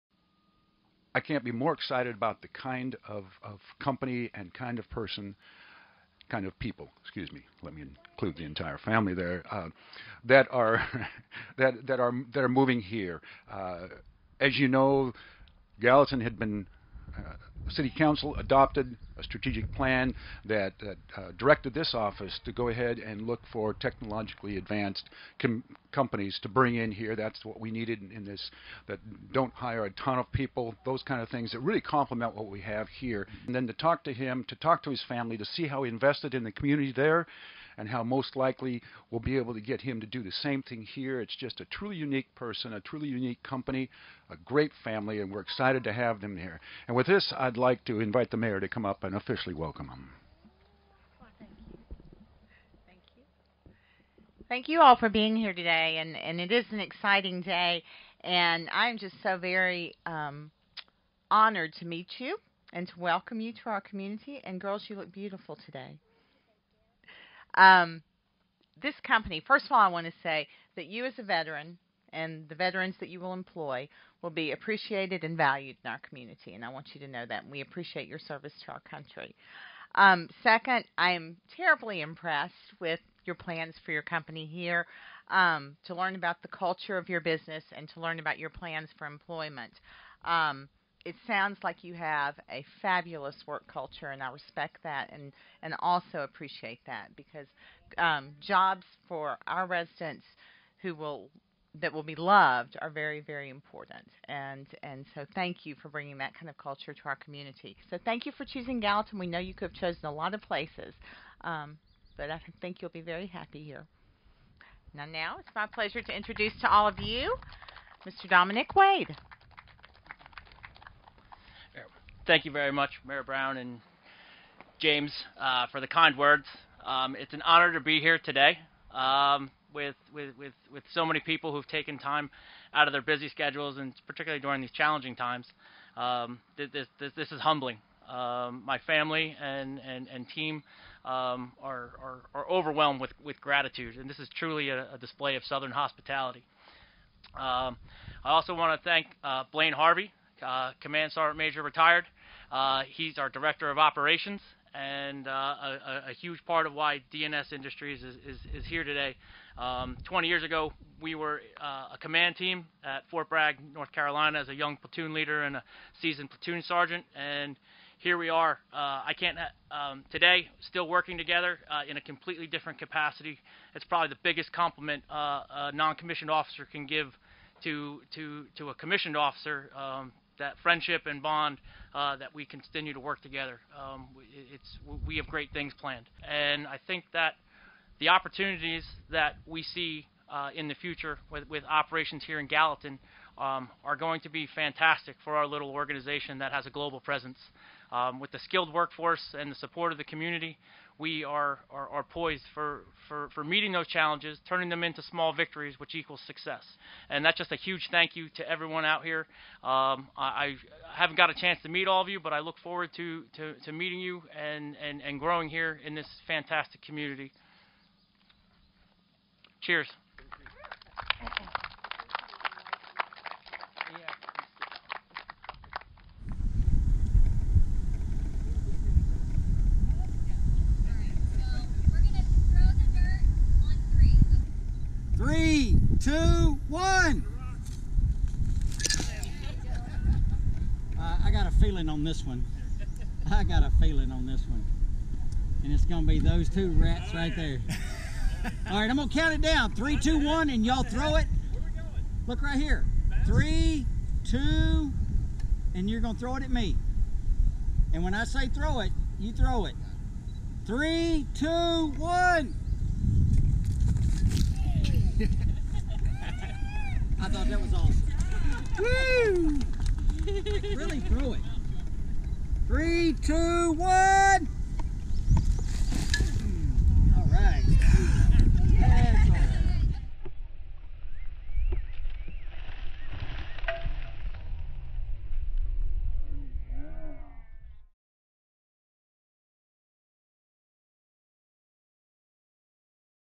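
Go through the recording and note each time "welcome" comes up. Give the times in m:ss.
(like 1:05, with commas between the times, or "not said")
0:49, 1:02.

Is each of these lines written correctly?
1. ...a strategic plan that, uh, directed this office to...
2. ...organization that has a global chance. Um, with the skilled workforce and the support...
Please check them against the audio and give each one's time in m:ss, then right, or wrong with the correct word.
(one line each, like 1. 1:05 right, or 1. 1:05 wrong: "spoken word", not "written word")
1. 0:19 right
2. 3:15 wrong: "presence", not "chance".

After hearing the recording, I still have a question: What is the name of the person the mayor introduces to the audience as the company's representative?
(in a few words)
Dominic Wade.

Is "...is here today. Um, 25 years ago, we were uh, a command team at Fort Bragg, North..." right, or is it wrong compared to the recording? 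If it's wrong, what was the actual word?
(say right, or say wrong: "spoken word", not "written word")
wrong: "20", not "25".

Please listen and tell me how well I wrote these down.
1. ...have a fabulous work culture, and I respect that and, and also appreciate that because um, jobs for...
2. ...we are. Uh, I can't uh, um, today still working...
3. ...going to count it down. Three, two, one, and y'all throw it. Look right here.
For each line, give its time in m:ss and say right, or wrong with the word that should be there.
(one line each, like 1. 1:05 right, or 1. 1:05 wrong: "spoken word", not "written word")
1. 1:31 right
2. 2:48 right
3. 4:08 right.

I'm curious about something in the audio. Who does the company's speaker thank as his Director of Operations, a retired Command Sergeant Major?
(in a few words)
Blaine Harvey.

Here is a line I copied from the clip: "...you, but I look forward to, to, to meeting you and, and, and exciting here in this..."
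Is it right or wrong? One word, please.
wrong.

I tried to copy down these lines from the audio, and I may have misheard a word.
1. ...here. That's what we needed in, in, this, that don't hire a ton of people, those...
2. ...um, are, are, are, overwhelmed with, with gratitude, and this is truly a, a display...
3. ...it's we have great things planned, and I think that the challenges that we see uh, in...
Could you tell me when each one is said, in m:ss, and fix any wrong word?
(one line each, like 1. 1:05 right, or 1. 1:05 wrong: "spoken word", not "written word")
1. 0:26 right
2. 2:21 right
3. 3:04 wrong: "opportunities", not "challenges".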